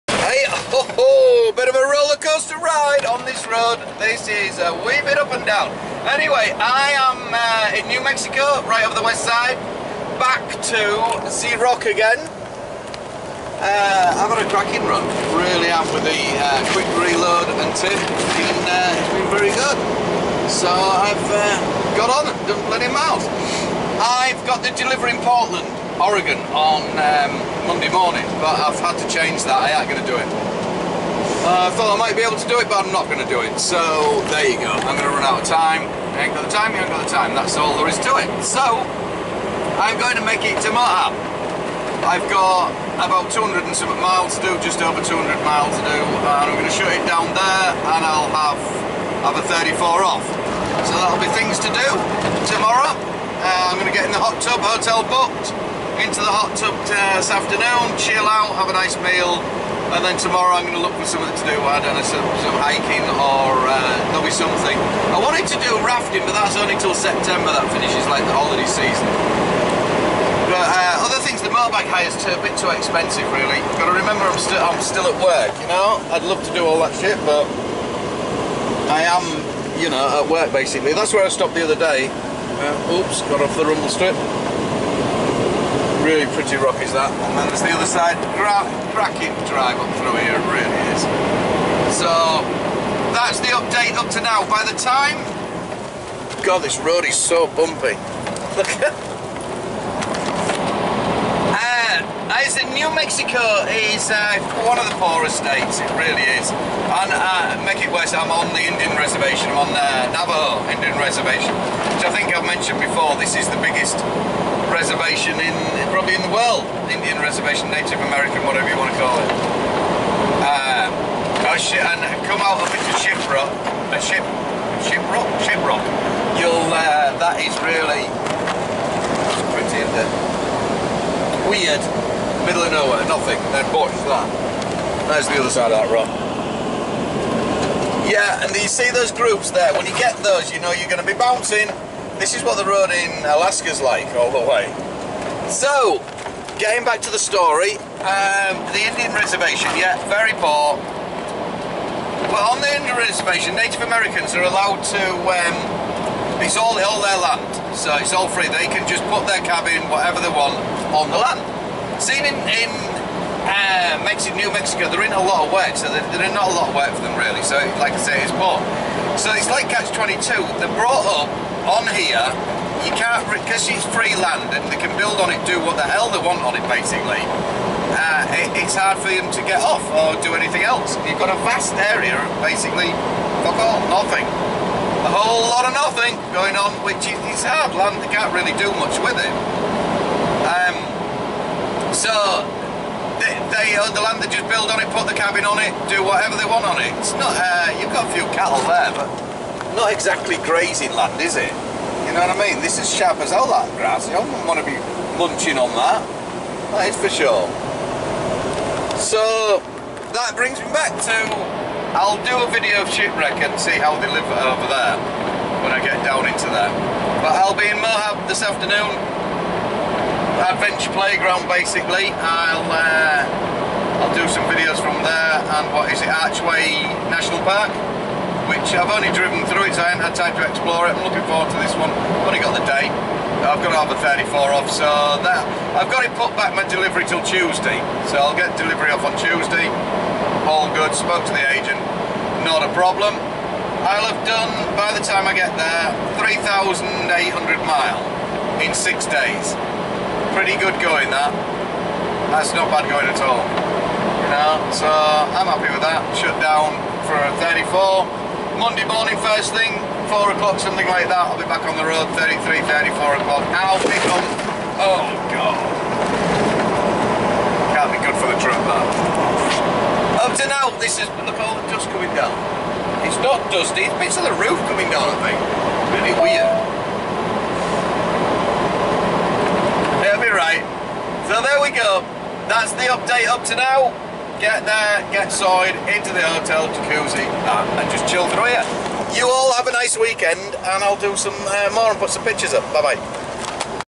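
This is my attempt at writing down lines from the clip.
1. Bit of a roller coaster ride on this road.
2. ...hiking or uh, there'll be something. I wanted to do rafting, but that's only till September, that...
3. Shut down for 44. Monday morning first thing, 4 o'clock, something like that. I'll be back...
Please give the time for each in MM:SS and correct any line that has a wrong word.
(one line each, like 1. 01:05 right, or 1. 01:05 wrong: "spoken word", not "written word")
1. 00:01 right
2. 01:02 right
3. 04:16 wrong: "34", not "44".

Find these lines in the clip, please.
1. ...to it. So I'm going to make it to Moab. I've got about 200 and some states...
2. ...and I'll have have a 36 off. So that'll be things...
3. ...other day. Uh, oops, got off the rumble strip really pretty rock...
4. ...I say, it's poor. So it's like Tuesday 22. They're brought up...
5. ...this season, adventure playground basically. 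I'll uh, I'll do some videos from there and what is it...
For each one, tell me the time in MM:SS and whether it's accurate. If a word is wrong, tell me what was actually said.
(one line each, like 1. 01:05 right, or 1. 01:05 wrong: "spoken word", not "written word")
1. 00:38 wrong: "miles", not "states"
2. 00:47 wrong: "34", not "36"
3. 01:21 right
4. 02:47 wrong: "Catch", not "Tuesday"
5. 03:38 wrong: "afternoon", not "season".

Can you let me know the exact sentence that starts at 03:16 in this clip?
It's not, uh, you've got a few cattle there, but not exactly grazing land, is it?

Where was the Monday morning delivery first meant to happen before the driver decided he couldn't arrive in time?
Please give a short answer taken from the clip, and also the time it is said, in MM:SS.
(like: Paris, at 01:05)
Portland, Oregon, at 00:25.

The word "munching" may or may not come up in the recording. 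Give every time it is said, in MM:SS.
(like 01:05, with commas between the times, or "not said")
03:25.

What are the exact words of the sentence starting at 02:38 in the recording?
They can just put their cabin, whatever they want, on the land.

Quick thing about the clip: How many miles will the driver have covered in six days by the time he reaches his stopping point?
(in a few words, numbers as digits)
3,800.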